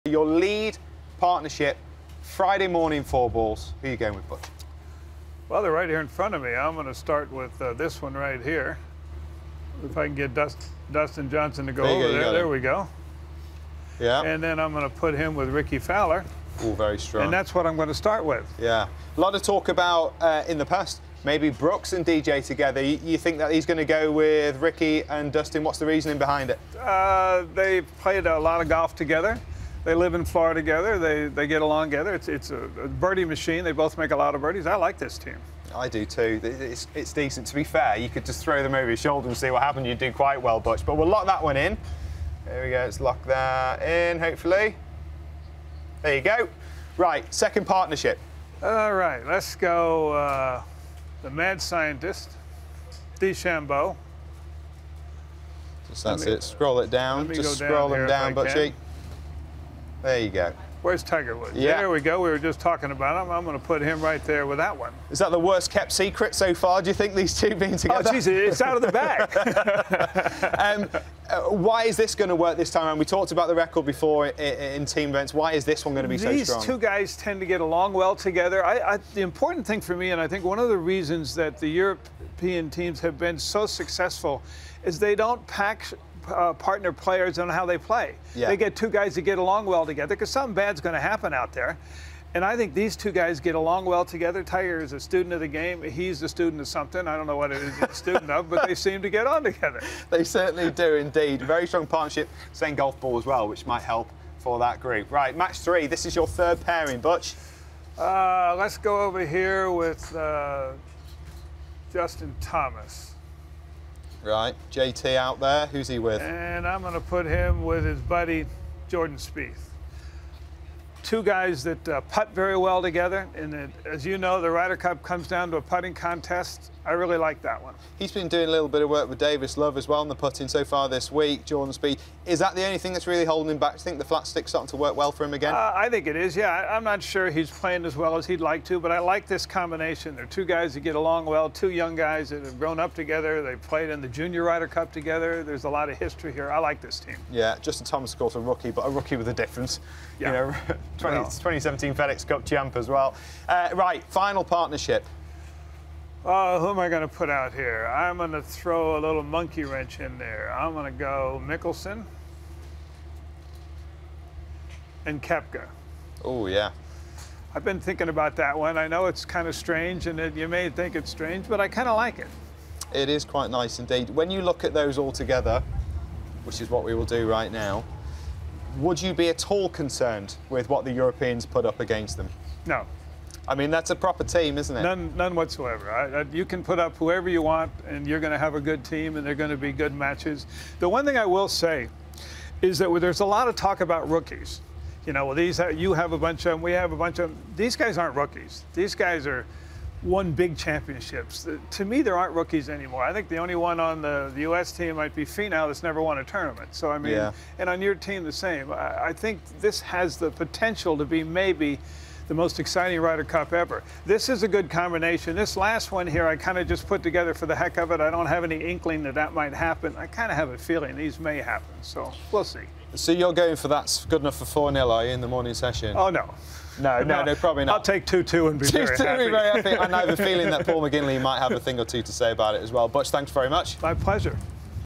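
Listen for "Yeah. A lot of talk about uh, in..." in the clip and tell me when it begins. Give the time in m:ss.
0:18.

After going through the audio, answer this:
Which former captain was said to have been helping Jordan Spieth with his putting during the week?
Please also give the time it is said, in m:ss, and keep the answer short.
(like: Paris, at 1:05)
Davis Love, at 2:09.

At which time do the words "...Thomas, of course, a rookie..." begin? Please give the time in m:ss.
2:27.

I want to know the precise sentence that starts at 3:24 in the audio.
team might be Finau that's never won a tournament.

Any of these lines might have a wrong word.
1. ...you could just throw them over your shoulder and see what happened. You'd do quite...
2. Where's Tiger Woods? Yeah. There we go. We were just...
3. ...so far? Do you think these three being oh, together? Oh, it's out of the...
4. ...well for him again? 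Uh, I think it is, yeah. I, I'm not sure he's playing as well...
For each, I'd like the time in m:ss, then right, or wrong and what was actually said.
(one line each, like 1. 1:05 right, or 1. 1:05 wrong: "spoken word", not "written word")
1. 0:37 right
2. 1:00 right
3. 1:06 wrong: "two", not "three"
4. 2:14 right.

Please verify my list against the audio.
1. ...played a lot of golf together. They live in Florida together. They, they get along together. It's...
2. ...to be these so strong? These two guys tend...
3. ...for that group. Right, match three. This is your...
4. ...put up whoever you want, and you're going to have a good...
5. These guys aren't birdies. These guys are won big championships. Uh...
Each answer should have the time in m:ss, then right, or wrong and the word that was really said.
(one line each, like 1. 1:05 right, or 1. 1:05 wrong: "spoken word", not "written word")
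1. 0:28 right
2. 1:16 right
3. 1:44 right
4. 3:06 right
5. 3:17 wrong: "rookies", not "birdies".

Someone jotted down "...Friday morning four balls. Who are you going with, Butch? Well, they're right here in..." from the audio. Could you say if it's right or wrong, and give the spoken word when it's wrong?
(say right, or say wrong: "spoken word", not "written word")
right.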